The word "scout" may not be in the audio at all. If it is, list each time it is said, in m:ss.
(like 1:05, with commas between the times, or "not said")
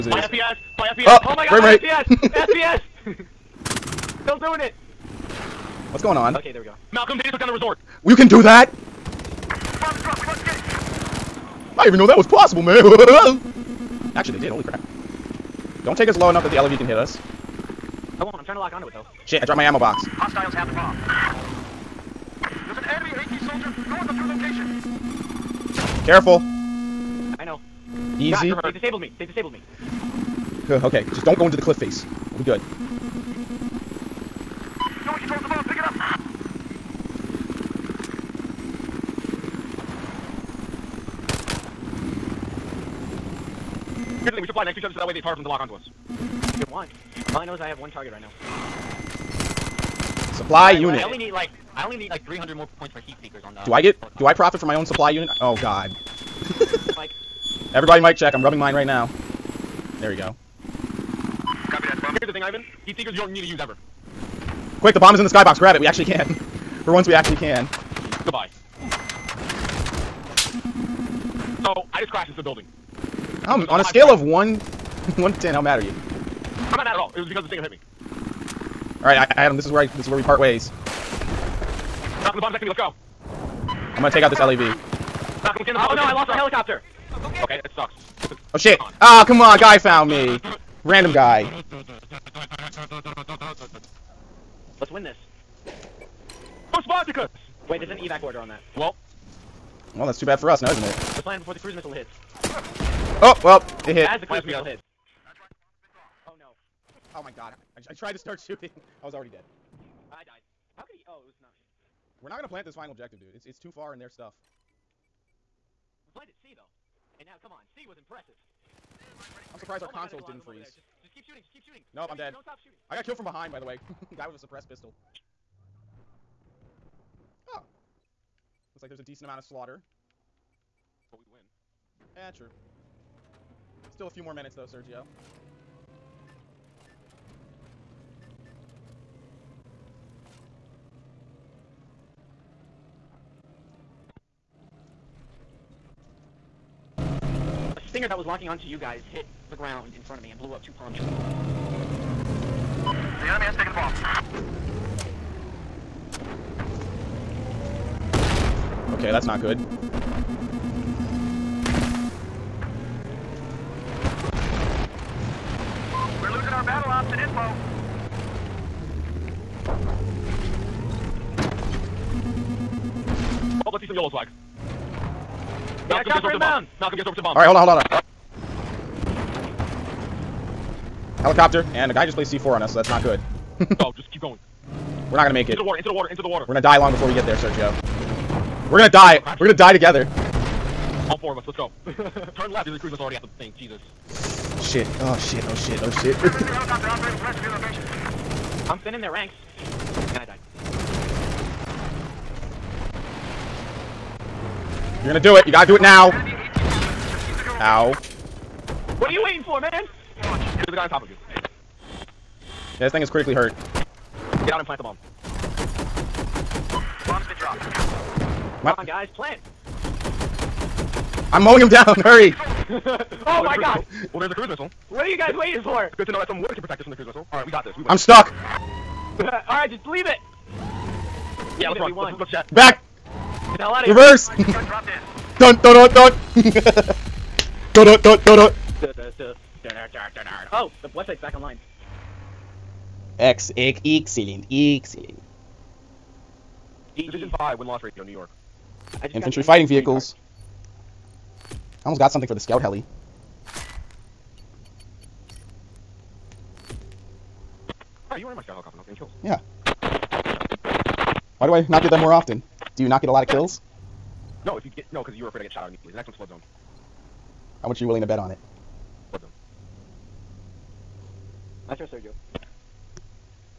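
4:12, 4:18.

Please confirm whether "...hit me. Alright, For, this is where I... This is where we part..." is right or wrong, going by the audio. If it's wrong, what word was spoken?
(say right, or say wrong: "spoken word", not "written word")
wrong: "Adam", not "For".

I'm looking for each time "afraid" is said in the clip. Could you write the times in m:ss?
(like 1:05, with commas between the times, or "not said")
4:25.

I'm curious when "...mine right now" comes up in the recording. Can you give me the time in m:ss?
0:58.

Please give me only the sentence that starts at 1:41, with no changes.
Let's land before the cruise missile hits.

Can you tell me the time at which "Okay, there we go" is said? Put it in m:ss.
0:06.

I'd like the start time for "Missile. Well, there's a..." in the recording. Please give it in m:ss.
3:43.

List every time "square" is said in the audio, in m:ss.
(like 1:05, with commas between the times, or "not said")
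not said.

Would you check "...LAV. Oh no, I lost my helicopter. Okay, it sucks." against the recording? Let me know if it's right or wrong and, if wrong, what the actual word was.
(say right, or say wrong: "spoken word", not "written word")
right.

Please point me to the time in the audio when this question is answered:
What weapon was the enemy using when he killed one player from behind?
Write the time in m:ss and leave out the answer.
2:04.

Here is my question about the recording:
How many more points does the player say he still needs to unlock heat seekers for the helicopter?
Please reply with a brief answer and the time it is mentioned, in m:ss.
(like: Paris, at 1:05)
300, at 0:52.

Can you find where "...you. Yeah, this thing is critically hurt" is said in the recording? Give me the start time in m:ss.
3:31.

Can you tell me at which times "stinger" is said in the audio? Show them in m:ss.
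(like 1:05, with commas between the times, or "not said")
1:17, 2:27.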